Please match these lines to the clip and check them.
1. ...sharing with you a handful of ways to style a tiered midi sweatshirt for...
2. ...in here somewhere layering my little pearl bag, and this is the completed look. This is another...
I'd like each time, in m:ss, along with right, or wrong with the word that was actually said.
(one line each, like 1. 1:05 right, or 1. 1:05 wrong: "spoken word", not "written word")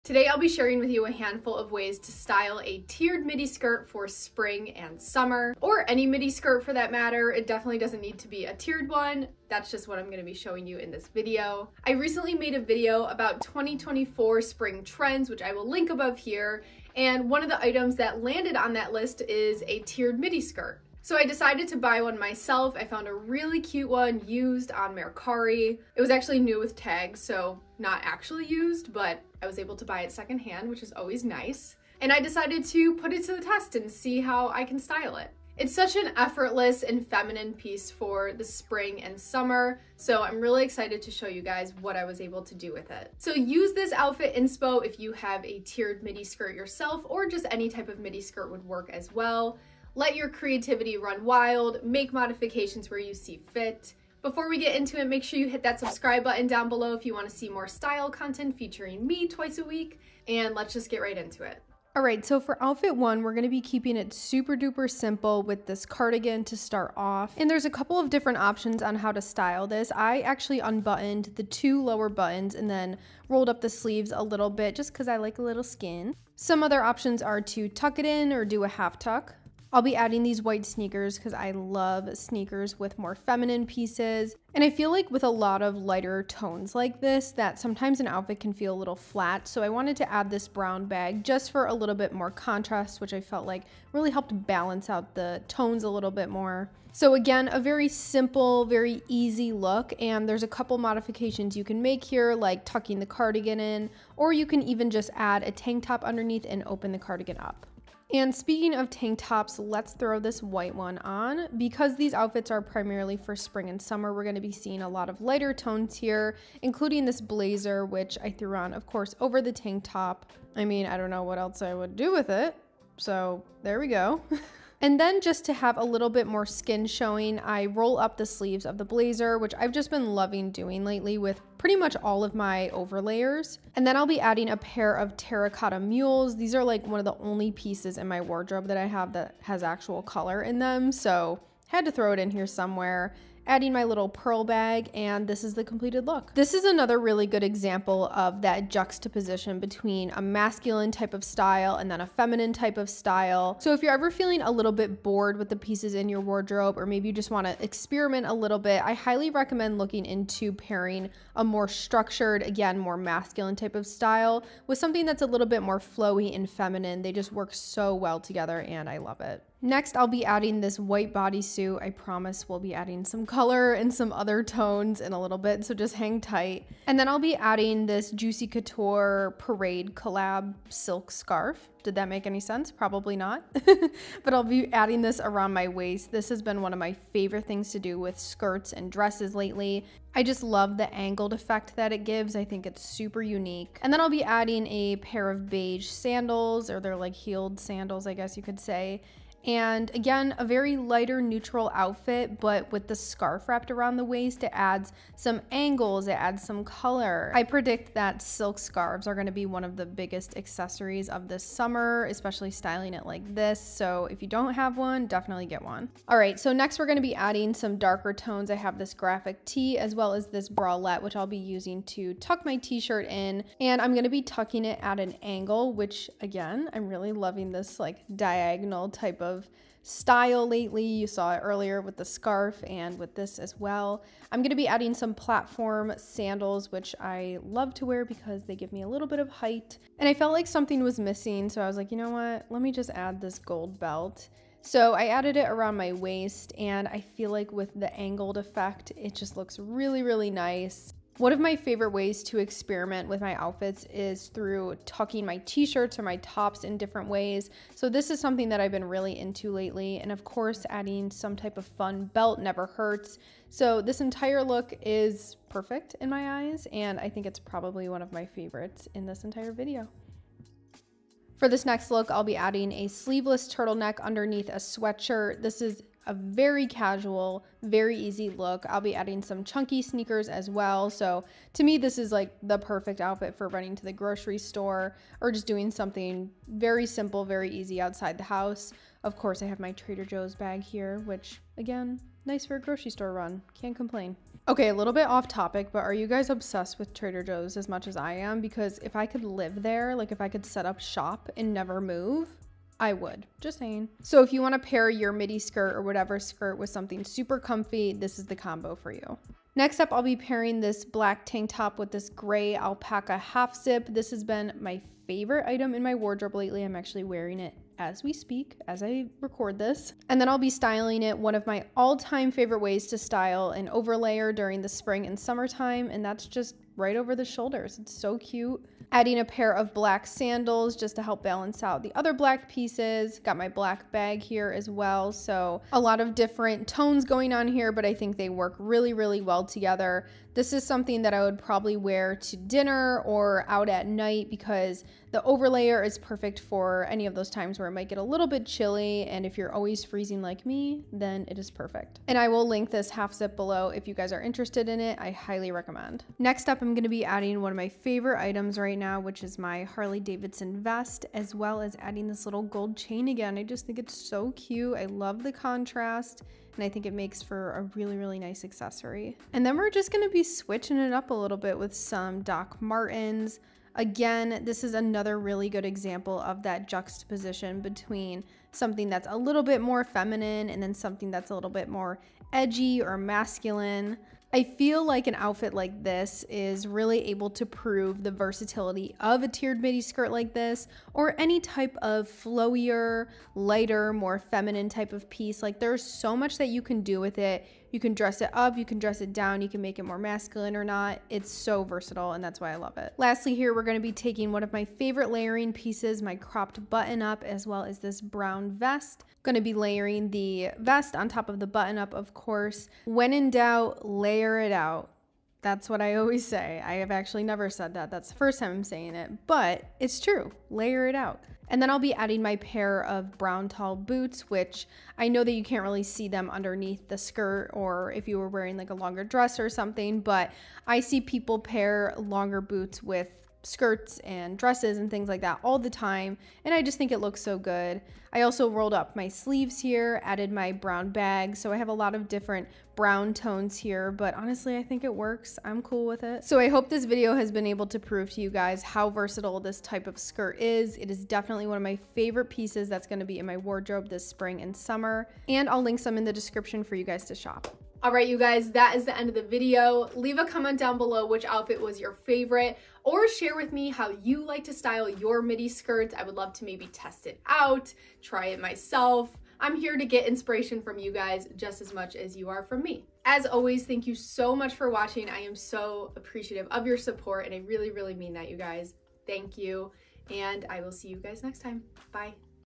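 1. 0:00 wrong: "skirt", not "sweatshirt"
2. 2:22 wrong: "adding", not "layering".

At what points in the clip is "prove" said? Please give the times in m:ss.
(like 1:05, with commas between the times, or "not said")
6:27, 7:27.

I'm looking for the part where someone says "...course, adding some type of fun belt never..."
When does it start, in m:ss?
4:20.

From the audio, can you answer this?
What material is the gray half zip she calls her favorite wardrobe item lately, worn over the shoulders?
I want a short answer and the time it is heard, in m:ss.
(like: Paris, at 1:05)
alpaca, at 5:12.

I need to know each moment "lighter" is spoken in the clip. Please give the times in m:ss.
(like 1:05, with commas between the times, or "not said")
1:25, 1:55, 3:20, 6:33.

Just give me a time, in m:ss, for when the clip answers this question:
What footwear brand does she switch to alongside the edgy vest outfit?
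6:12.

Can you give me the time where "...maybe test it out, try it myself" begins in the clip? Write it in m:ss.
7:46.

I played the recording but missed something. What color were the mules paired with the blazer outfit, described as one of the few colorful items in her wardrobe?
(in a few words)
terracotta.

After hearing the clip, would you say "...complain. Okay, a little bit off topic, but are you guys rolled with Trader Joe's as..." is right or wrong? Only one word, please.
wrong.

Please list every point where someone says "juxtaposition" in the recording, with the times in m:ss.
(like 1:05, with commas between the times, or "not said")
2:28, 6:16.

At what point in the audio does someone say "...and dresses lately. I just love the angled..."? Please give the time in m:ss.
3:08.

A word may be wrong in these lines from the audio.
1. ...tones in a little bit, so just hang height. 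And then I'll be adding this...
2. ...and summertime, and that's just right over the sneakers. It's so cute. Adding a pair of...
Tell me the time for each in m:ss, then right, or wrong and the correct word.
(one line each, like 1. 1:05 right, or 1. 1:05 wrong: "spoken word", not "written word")
1. 2:54 wrong: "tight", not "height"
2. 5:25 wrong: "shoulders", not "sneakers".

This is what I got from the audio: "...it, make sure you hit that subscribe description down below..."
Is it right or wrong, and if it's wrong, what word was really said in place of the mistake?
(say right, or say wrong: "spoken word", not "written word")
wrong: "button", not "description".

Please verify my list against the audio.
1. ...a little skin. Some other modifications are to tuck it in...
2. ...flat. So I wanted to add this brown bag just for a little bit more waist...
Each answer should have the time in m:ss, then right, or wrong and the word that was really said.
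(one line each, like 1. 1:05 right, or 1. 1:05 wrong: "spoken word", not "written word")
1. 1:15 wrong: "options", not "modifications"
2. 1:28 wrong: "contrast", not "waist".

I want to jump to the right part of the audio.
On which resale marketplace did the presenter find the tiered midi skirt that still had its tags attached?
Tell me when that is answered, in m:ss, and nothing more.
0:24.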